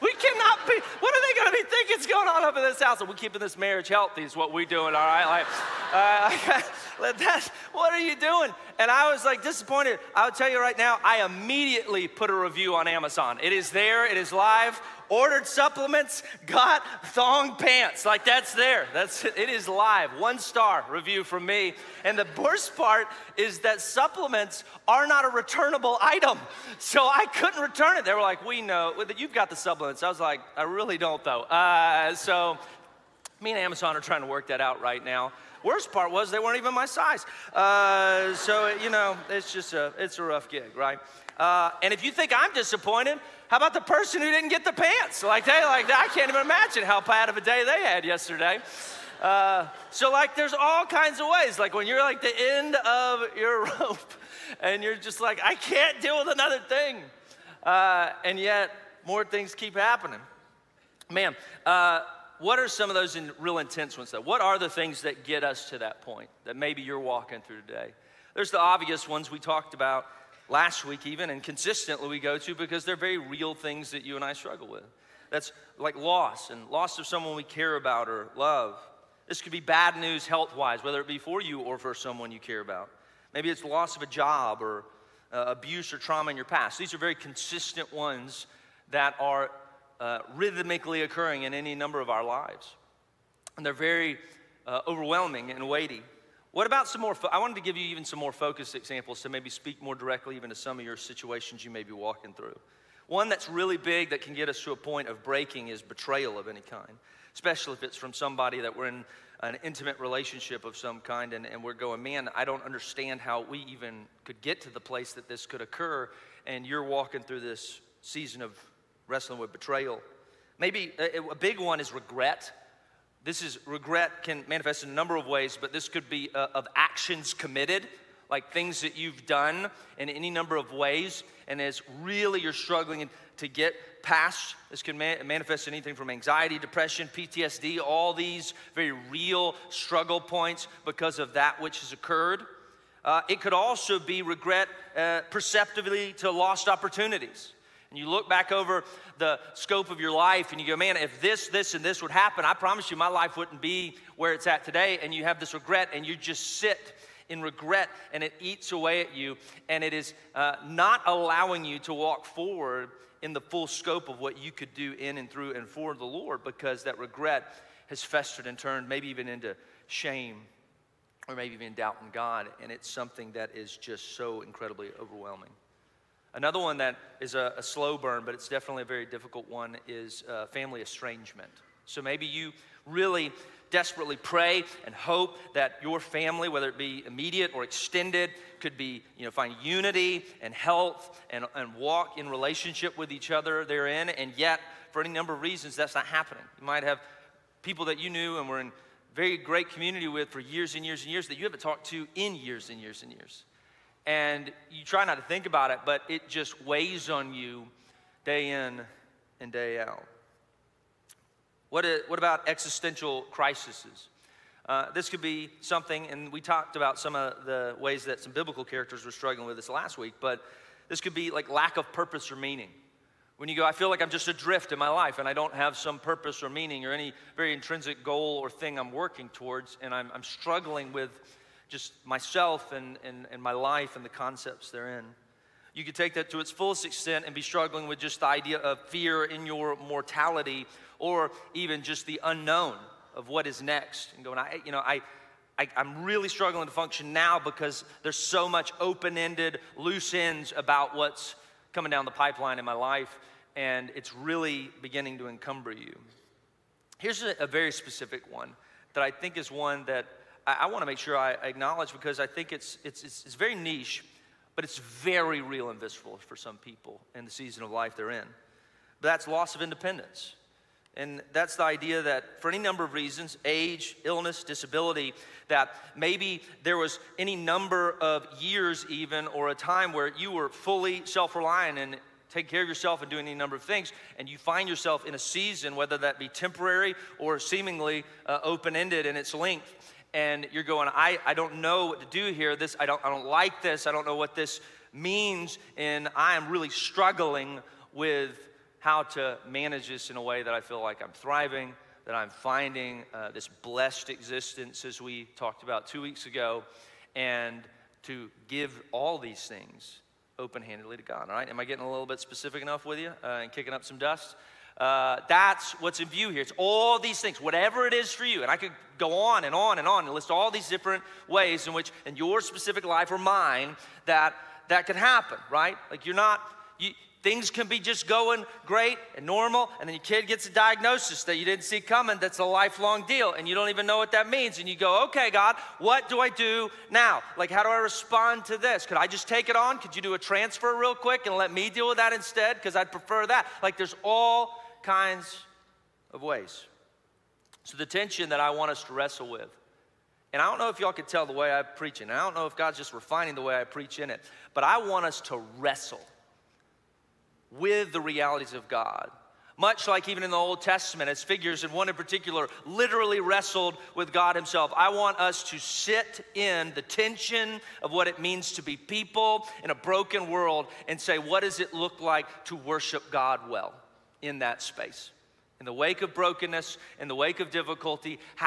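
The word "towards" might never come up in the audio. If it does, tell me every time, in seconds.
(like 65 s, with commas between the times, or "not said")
229 s.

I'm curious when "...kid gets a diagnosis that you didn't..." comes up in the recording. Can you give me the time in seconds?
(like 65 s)
330 s.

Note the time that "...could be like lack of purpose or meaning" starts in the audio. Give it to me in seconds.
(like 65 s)
220 s.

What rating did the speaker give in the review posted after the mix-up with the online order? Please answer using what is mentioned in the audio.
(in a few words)
1 star.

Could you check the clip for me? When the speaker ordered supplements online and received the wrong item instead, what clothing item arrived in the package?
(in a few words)
thong pants.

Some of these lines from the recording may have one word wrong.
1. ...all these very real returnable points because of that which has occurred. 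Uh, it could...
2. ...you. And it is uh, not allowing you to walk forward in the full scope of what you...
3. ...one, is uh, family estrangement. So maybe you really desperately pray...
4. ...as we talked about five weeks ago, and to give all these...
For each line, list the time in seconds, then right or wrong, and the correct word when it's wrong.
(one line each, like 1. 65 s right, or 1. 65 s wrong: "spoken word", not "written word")
1. 137 s wrong: "struggle", not "returnable"
2. 159 s right
3. 179 s right
4. 304 s wrong: "two", not "five".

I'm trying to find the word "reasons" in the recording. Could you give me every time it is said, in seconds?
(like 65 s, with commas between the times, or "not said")
195 s, 272 s.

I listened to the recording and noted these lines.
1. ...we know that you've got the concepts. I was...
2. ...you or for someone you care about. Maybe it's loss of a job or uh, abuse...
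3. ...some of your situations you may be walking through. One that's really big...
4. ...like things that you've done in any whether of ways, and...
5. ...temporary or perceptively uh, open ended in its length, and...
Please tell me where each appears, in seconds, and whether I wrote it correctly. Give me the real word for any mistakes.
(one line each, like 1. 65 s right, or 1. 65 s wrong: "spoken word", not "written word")
1. 28 s wrong: "supplements", not "concepts"
2. 81 s right
3. 100 s right
4. 128 s wrong: "number", not "whether"
5. 286 s wrong: "seemingly", not "perceptively".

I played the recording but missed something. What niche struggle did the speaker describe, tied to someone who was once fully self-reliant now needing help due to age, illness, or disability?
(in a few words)
loss of independence.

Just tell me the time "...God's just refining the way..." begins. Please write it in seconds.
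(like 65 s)
352 s.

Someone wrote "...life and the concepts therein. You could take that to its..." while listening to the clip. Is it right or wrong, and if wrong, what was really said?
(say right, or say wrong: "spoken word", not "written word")
right.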